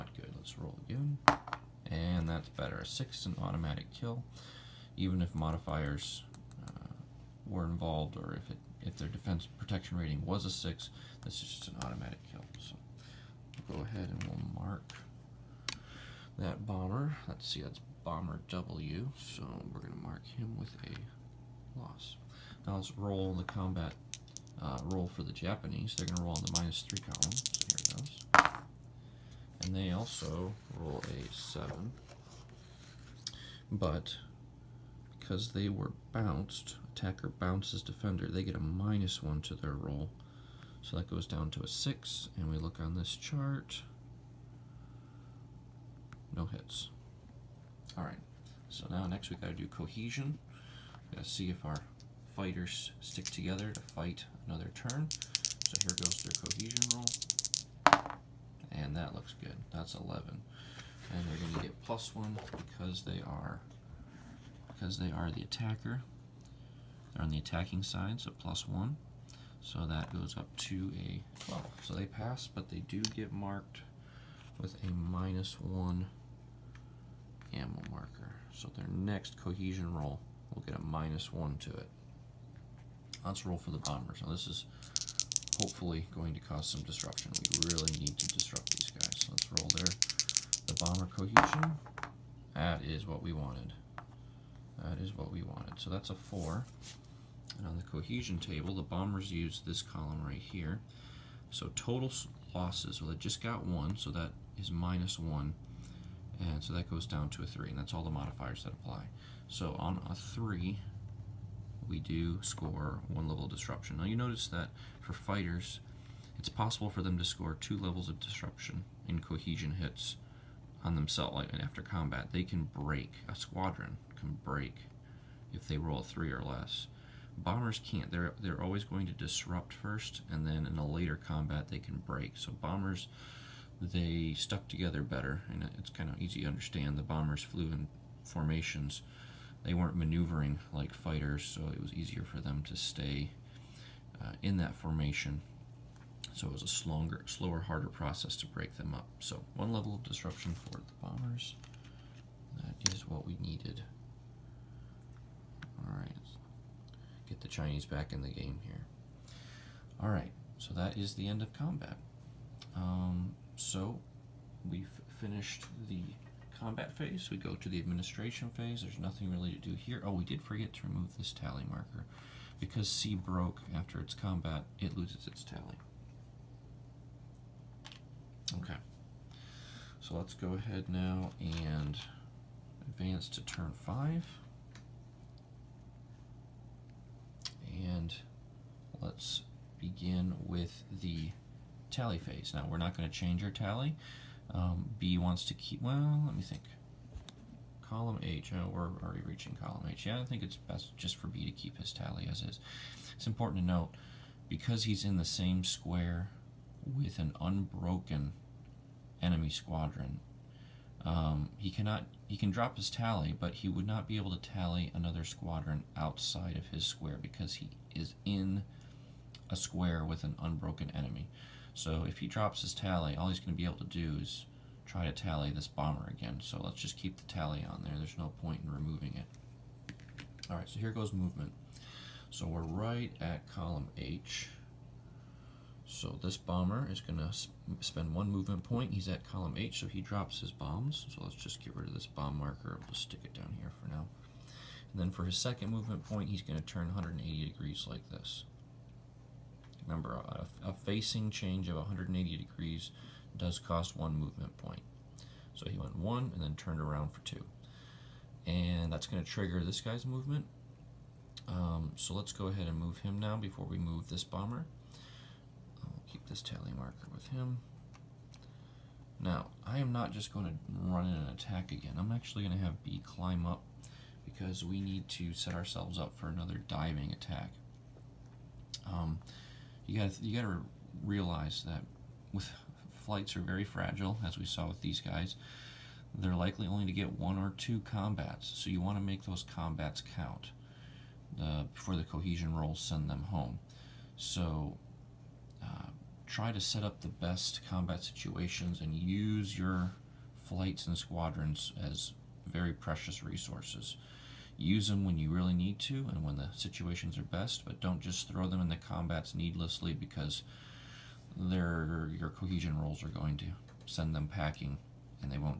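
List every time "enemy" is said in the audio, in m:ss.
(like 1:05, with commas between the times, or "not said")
3:29, 3:40.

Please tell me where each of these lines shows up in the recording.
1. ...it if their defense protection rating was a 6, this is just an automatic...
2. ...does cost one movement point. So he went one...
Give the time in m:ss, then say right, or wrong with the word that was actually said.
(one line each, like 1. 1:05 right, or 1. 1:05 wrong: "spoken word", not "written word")
1. 0:08 right
2. 4:13 right.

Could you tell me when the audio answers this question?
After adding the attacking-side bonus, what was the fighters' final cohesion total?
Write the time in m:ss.
1:11.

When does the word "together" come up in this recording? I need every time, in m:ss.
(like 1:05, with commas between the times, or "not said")
0:53, 2:14.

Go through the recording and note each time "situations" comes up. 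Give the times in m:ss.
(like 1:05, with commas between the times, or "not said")
4:58, 5:06.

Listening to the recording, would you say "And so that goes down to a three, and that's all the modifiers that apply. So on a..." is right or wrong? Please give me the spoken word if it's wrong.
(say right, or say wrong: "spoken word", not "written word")
right.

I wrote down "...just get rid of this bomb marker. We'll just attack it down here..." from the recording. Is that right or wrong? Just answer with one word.
wrong.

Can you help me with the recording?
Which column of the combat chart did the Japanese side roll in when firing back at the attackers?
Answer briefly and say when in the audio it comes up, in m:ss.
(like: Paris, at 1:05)
minus 3 column, at 0:26.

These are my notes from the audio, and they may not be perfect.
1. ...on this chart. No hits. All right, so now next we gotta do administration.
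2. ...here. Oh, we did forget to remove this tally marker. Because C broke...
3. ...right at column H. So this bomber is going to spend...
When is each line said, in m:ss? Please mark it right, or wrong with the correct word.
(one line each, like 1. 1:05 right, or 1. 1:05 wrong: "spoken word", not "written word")
1. 0:42 wrong: "cohesion", not "administration"
2. 2:49 right
3. 3:52 right.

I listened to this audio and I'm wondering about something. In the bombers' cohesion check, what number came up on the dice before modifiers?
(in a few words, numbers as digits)
4.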